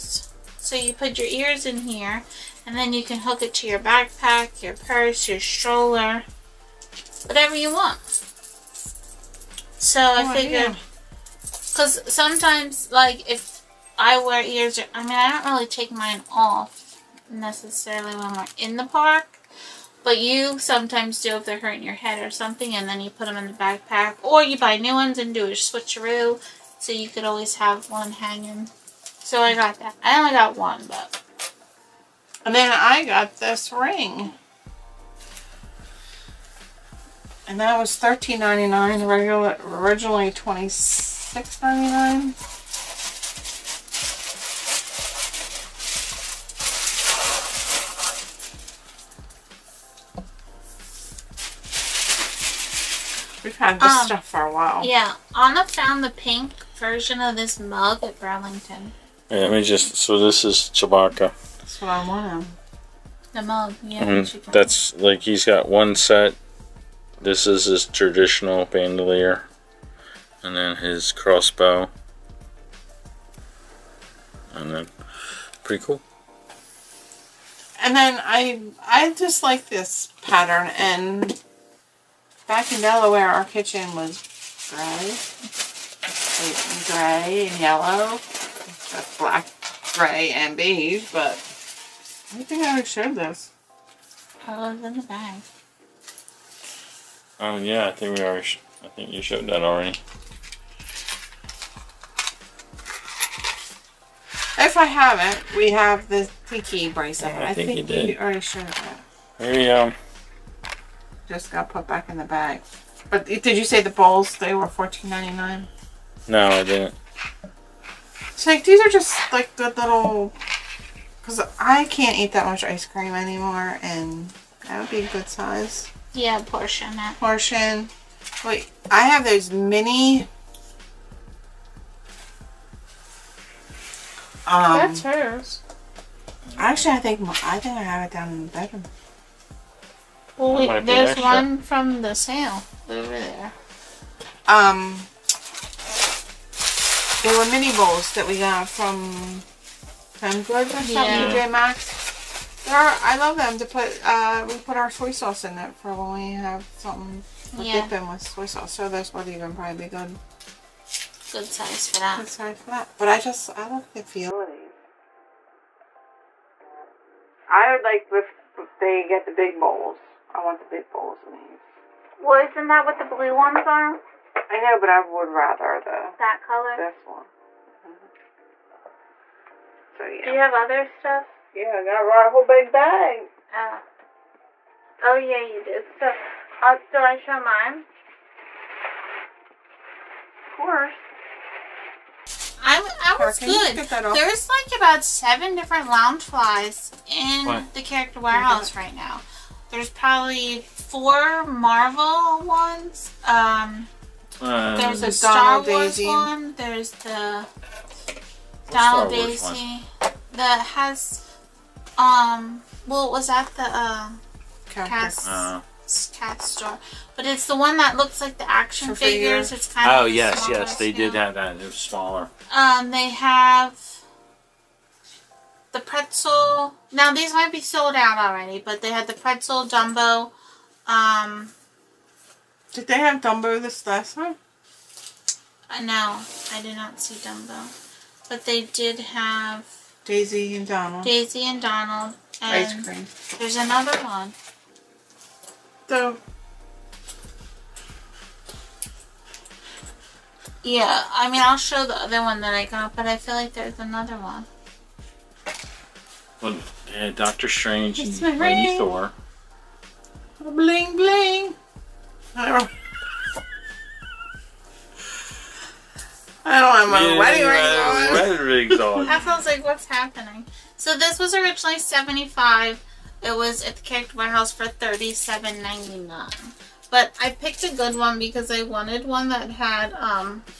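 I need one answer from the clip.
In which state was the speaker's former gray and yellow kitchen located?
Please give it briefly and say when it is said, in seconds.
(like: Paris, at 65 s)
Delaware, at 82 s.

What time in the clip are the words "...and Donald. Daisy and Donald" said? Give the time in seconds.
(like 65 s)
240 s.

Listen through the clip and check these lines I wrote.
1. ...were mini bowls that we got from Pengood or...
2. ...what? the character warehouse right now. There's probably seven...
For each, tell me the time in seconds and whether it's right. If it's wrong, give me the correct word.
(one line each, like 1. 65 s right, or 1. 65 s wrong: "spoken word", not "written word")
1. 147 s right
2. 197 s wrong: "four", not "seven".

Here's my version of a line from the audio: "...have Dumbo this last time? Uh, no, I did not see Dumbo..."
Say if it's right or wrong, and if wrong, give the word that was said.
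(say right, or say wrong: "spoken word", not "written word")
right.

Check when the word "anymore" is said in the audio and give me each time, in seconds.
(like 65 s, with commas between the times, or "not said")
123 s.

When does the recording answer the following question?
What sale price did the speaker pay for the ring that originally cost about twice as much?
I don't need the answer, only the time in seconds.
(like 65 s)
37 s.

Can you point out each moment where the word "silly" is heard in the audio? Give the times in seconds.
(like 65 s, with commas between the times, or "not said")
not said.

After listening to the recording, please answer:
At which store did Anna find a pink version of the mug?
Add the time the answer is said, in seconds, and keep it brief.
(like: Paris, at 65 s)
Burlington, at 58 s.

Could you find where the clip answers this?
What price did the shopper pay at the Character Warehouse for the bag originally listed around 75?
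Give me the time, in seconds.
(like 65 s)
274 s.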